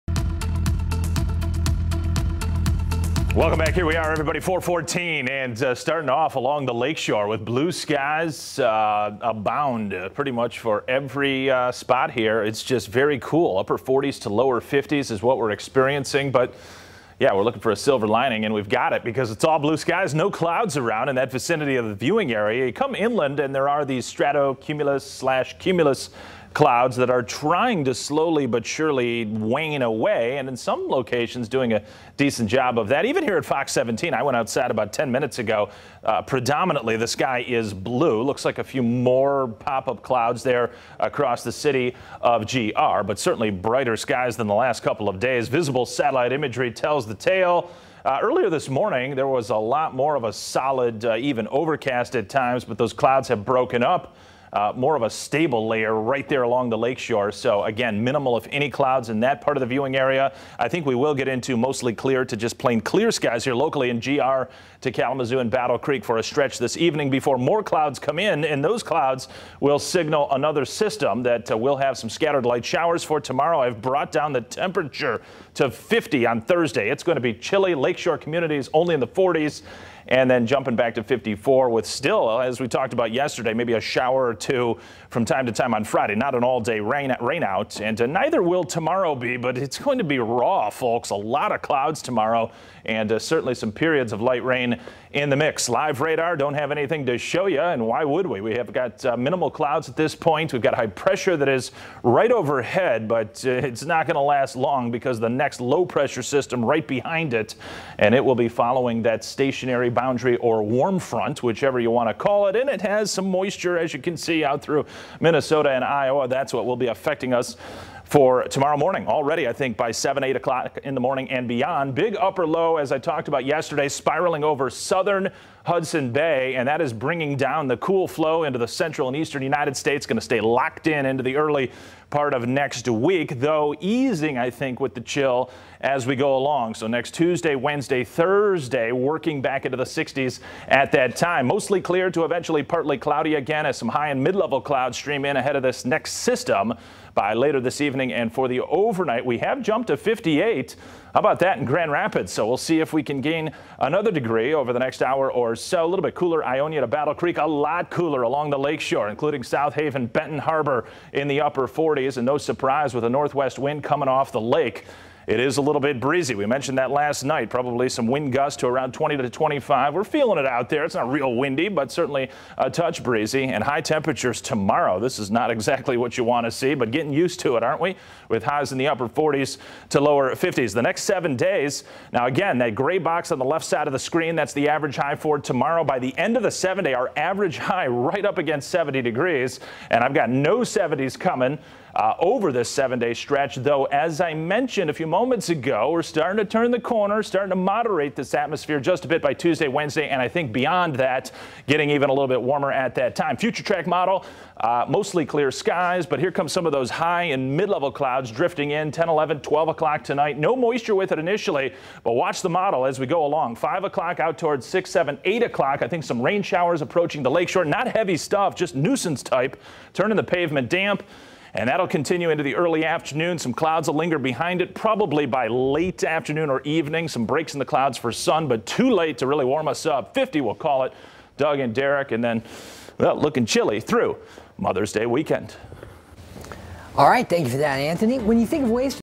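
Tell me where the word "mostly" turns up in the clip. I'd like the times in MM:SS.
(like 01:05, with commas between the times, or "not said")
01:01, 02:21, 03:24.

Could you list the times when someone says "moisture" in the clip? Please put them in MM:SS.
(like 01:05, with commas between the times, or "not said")
01:53, 03:30.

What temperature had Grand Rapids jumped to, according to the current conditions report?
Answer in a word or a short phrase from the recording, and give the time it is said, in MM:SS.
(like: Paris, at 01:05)
58, at 02:29.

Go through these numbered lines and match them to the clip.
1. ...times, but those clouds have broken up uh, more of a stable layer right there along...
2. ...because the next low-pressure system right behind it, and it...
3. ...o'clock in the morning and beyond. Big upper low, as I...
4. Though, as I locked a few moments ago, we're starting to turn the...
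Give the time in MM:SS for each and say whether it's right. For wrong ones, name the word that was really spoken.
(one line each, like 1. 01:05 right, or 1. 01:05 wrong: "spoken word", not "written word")
1. 00:52 right
2. 01:44 right
3. 02:00 right
4. 03:13 wrong: "mentioned", not "locked".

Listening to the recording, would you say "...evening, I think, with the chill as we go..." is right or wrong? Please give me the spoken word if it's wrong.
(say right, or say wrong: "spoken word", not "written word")
wrong: "easing", not "evening".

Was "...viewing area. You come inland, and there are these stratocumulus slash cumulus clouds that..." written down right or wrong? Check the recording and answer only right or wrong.
right.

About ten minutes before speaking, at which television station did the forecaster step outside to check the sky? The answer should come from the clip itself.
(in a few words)
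Fox 17.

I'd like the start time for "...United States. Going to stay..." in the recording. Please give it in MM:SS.
02:09.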